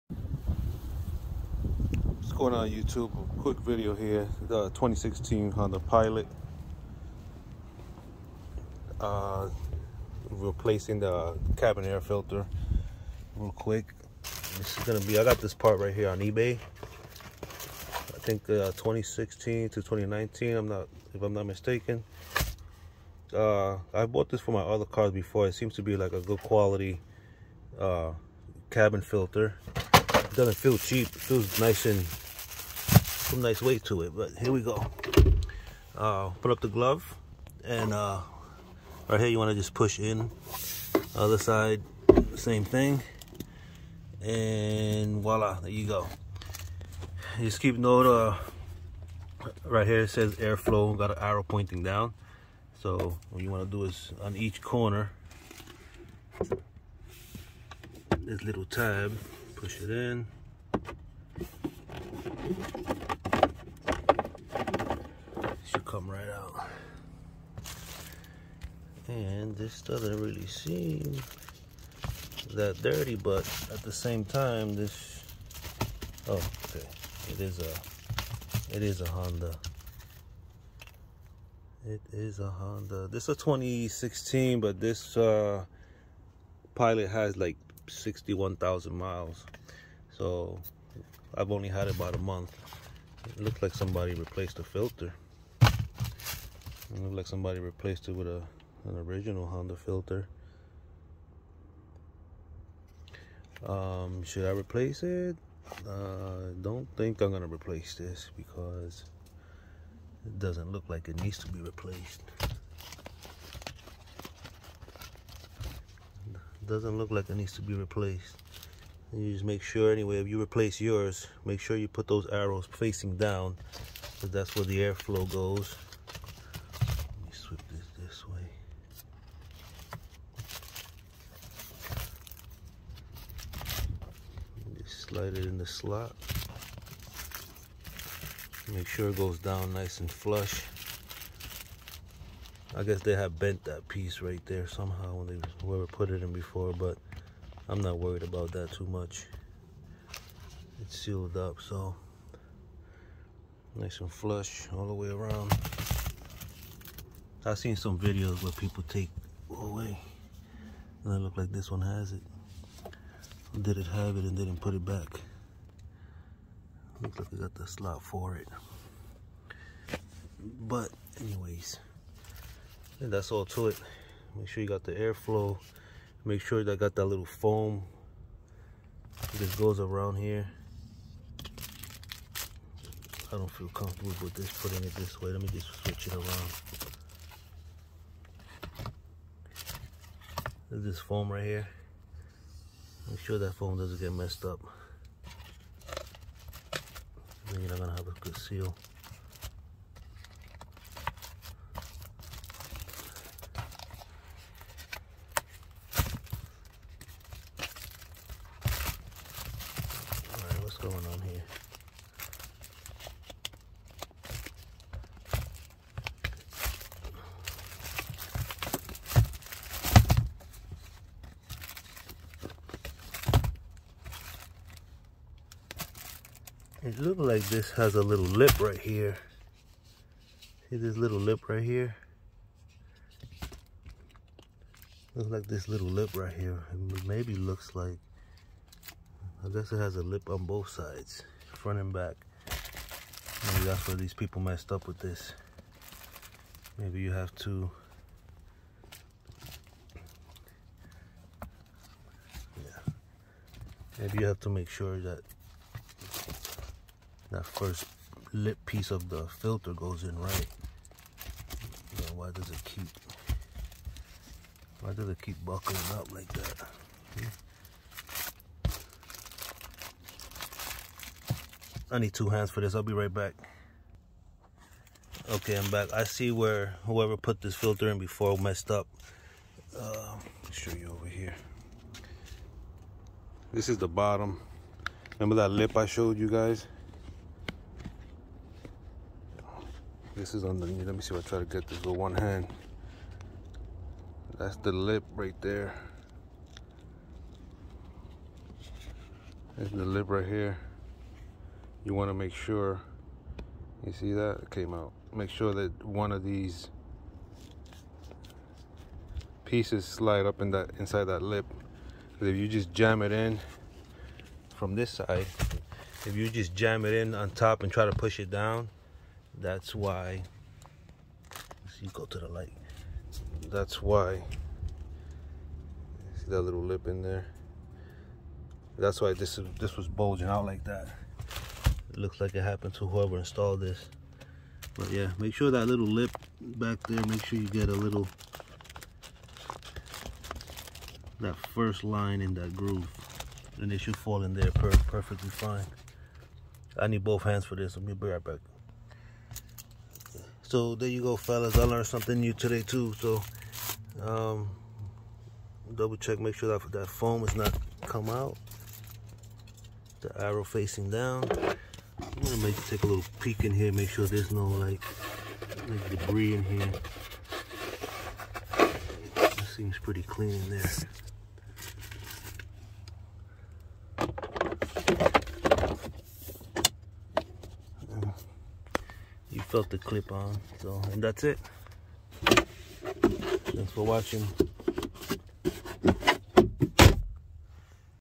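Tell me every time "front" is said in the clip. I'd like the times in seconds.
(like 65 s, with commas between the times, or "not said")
241 s.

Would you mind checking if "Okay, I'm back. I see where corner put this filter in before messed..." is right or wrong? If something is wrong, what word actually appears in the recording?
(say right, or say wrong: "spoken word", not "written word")
wrong: "whoever", not "corner".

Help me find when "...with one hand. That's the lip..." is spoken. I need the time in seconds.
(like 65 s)
291 s.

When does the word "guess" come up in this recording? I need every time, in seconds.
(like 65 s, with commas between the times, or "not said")
142 s, 239 s.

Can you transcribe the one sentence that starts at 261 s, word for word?
Now why does it keep, why does it keep buckling up like that?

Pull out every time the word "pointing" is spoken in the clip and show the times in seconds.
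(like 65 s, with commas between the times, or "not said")
51 s.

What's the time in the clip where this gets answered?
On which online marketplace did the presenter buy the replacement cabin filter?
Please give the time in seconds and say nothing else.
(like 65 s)
16 s.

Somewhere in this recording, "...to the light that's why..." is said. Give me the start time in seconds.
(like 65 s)
322 s.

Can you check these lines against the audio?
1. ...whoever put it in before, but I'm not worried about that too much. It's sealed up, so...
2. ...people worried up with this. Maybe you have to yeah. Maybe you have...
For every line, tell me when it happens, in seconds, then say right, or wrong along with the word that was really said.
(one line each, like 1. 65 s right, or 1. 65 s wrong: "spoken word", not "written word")
1. 145 s right
2. 244 s wrong: "messed", not "worried".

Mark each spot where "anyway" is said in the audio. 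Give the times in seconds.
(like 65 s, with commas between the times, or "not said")
119 s, 171 s.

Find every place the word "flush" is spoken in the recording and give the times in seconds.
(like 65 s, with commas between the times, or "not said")
140 s, 154 s.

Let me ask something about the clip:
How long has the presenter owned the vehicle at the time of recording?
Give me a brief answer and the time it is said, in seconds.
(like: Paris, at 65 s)
about a month, at 91 s.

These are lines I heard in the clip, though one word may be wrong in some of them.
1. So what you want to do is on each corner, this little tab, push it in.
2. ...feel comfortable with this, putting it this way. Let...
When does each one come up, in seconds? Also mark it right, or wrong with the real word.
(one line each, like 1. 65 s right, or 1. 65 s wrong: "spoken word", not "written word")
1. 52 s right
2. 183 s right.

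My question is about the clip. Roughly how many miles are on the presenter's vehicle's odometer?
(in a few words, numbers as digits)
61,000.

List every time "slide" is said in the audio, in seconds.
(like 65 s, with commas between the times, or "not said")
135 s, 309 s.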